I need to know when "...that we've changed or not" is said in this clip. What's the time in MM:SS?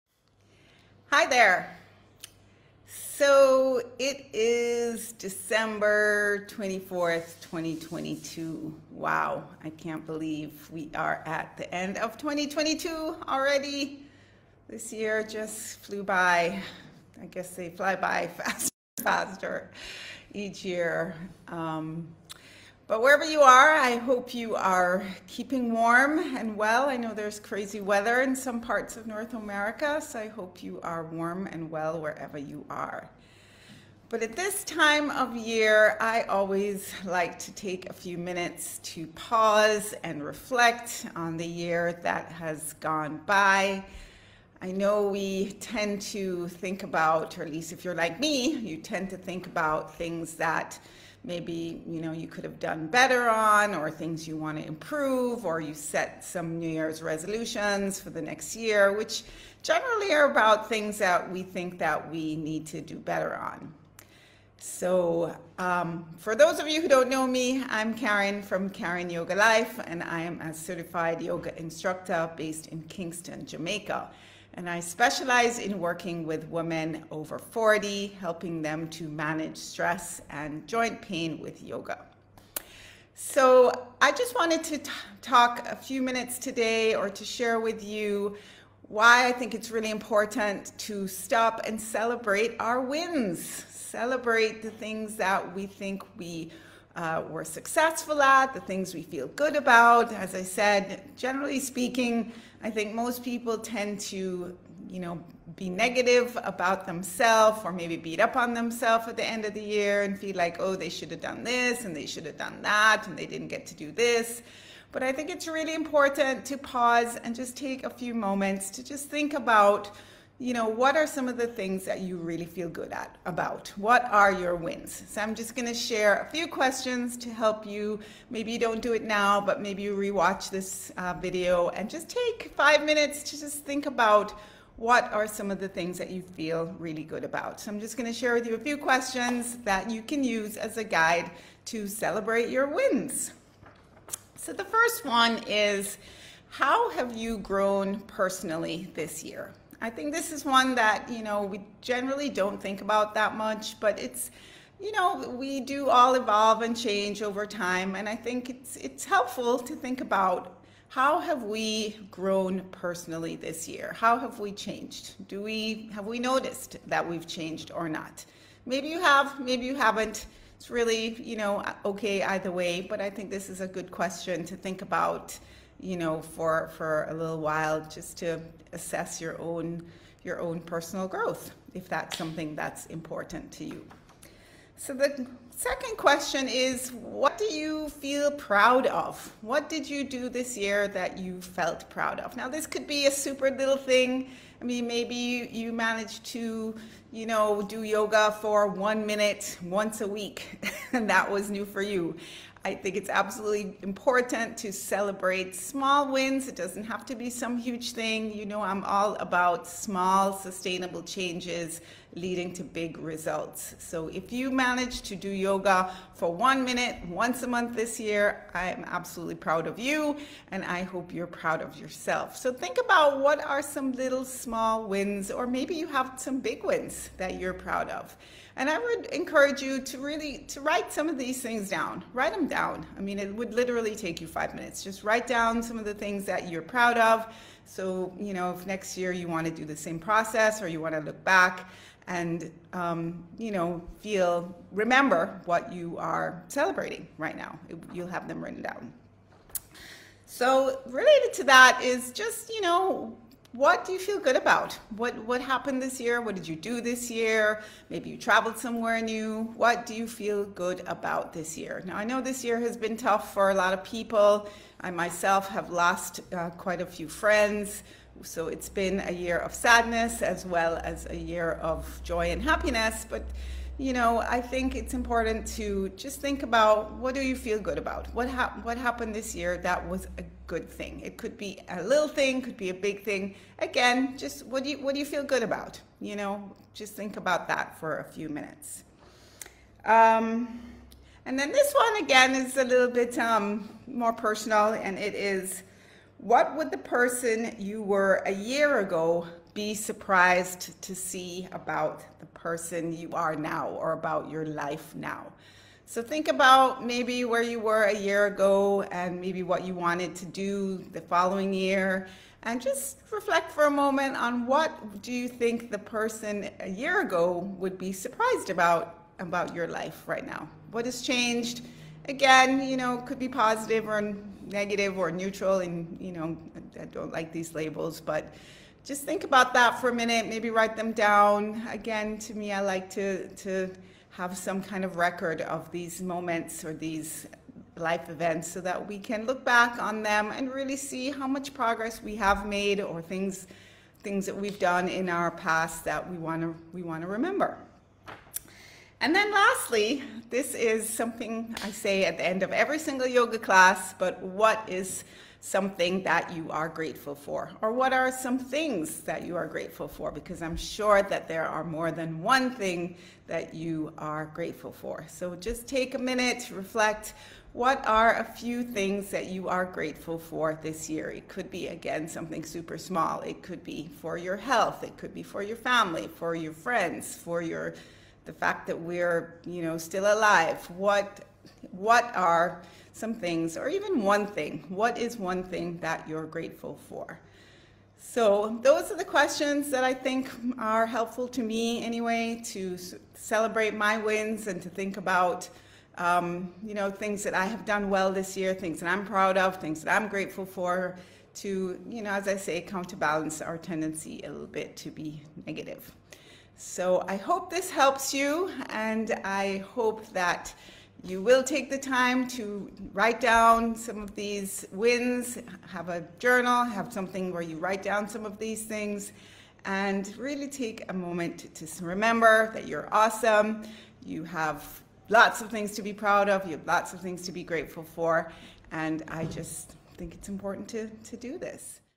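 02:46.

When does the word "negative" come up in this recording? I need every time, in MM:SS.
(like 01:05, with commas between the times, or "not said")
01:45, 05:24, 06:45.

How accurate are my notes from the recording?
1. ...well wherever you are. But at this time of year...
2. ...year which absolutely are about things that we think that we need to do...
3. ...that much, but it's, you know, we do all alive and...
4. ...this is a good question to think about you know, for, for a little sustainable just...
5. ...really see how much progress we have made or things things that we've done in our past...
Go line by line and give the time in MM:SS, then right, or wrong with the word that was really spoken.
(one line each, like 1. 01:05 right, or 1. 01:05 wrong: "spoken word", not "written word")
1. 00:31 right
2. 00:58 wrong: "generally", not "absolutely"
3. 02:33 wrong: "evolve", not "alive"
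4. 02:53 wrong: "while", not "sustainable"
5. 05:40 right.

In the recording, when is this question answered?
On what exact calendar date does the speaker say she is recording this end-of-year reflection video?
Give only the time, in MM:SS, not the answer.
00:05.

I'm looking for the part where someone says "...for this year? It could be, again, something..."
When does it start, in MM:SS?
06:10.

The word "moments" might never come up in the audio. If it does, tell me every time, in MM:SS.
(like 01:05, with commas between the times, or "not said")
01:58, 05:13, 05:36, 07:00.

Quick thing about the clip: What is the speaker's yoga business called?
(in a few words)
Karin Yoga Life.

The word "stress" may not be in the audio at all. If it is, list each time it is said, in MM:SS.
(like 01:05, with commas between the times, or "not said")
01:19.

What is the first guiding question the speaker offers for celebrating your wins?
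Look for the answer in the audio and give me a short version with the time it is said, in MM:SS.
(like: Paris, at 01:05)
How have you grown personally, at 02:26.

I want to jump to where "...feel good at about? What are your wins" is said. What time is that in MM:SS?
02:02.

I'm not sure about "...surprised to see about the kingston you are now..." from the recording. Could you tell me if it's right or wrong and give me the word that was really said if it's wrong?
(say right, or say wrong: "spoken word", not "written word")
wrong: "person", not "kingston".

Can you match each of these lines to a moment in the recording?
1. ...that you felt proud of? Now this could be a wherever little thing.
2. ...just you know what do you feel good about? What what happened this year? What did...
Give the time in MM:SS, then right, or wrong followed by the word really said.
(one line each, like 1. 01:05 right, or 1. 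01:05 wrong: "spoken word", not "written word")
1. 03:10 wrong: "super", not "wherever"
2. 04:12 right.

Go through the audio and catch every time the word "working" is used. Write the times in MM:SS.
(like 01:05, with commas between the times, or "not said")
01:15.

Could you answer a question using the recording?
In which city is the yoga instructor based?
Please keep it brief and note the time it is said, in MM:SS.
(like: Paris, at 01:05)
Kingston, Jamaica, at 01:12.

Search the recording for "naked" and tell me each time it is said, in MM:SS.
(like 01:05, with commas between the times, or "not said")
not said.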